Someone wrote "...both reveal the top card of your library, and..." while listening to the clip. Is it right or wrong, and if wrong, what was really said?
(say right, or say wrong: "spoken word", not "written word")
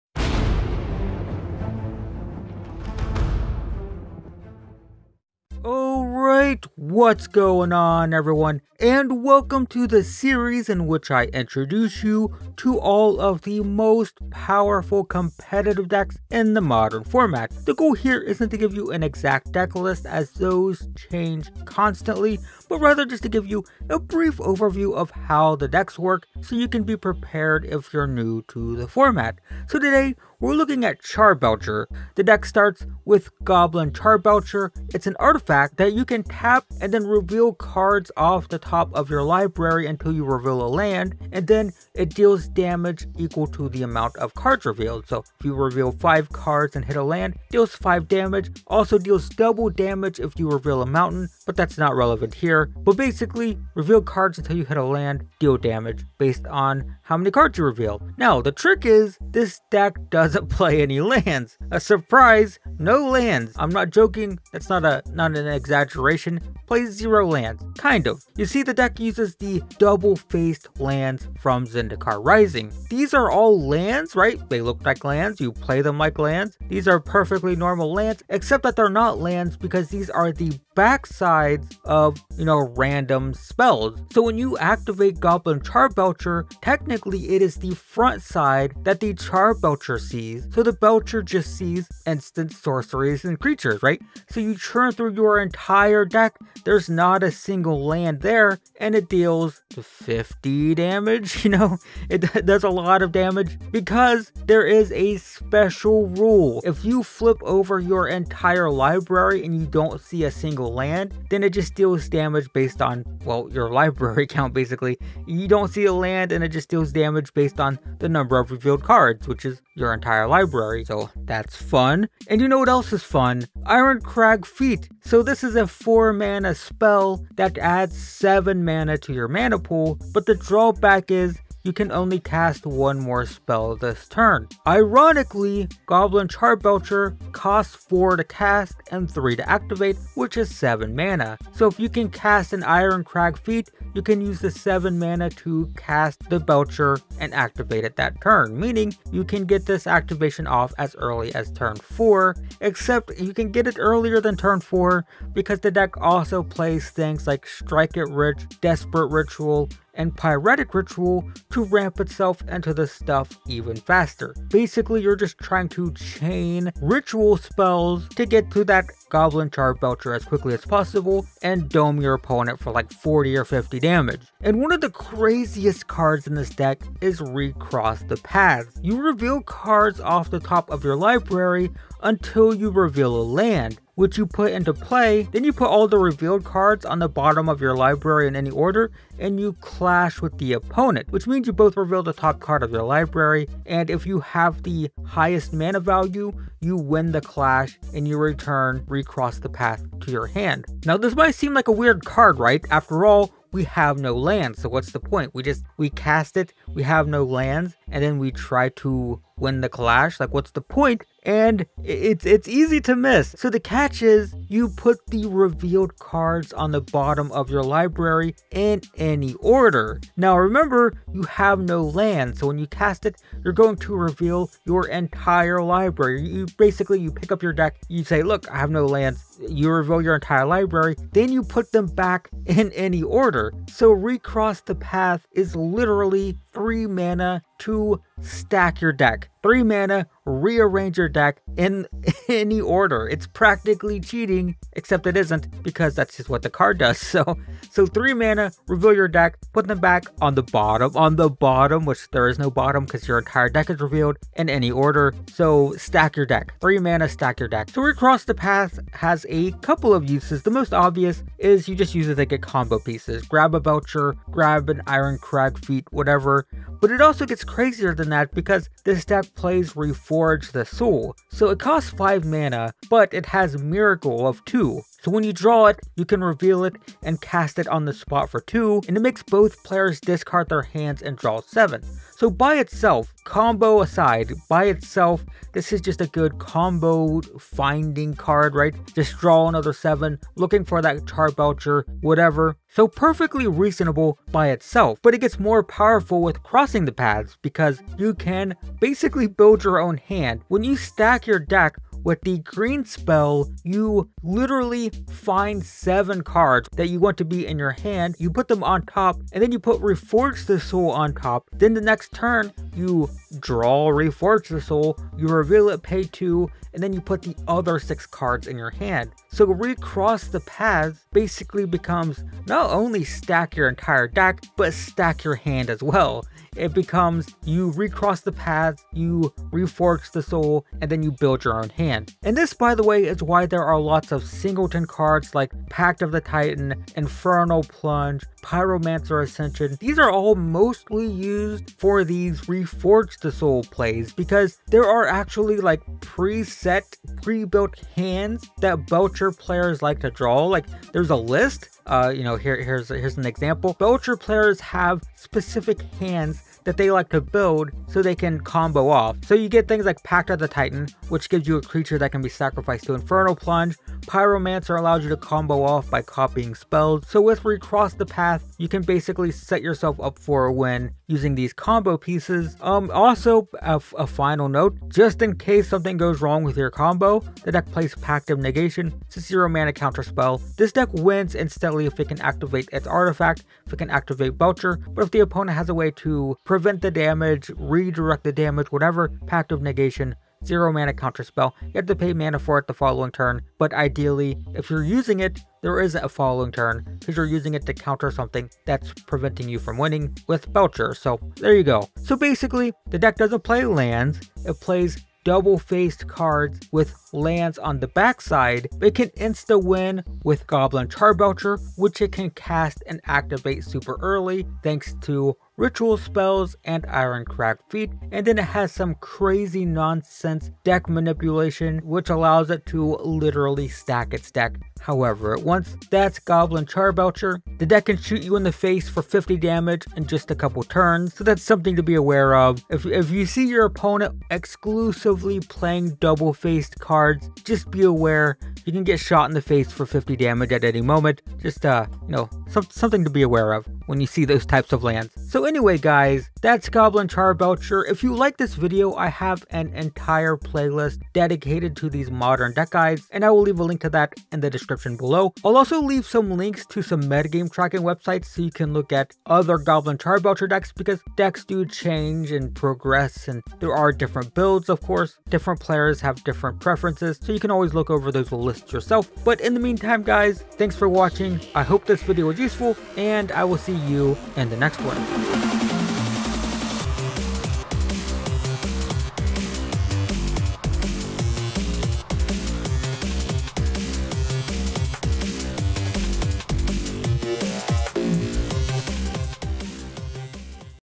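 right.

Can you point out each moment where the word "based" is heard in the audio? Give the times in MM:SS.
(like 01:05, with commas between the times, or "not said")
00:56, 01:52, 01:57.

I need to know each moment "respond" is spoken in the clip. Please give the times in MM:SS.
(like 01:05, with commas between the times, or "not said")
not said.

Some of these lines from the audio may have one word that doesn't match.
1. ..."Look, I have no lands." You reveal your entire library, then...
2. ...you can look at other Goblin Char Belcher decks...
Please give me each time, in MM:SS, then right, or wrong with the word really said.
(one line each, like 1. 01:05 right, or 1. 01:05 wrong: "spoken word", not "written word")
1. 03:48 right
2. 07:38 right.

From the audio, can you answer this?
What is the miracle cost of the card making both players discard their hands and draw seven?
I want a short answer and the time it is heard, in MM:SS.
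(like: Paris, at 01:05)
2, at 04:33.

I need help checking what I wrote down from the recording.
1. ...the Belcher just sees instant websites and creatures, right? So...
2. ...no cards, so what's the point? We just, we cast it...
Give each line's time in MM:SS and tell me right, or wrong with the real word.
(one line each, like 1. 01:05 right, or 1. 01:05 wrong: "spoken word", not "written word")
1. 01:30 wrong: "sorceries", not "websites"
2. 03:23 wrong: "lands", not "cards".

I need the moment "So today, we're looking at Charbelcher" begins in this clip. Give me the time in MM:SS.
00:29.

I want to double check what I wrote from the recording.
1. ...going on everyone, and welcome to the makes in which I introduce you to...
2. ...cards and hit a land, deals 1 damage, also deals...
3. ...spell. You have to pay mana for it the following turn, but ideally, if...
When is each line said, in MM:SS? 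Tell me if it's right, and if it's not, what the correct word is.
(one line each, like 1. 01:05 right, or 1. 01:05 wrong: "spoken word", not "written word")
1. 00:07 wrong: "series", not "makes"
2. 00:46 wrong: "5", not "1"
3. 06:31 right.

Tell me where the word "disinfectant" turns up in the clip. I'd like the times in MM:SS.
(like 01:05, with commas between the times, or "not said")
not said.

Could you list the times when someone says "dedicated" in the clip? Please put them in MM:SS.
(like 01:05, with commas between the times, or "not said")
07:31.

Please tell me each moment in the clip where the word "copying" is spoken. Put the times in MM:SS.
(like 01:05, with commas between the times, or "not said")
06:06.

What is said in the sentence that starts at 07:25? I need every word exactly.
So anyway guys, that's Goblin Char Belcher.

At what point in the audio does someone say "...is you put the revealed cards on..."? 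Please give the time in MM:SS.
03:34.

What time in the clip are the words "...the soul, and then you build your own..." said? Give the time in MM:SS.
05:30.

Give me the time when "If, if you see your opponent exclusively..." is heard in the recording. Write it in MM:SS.
07:12.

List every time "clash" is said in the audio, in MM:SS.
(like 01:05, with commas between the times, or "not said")
03:09, 03:17, 03:29.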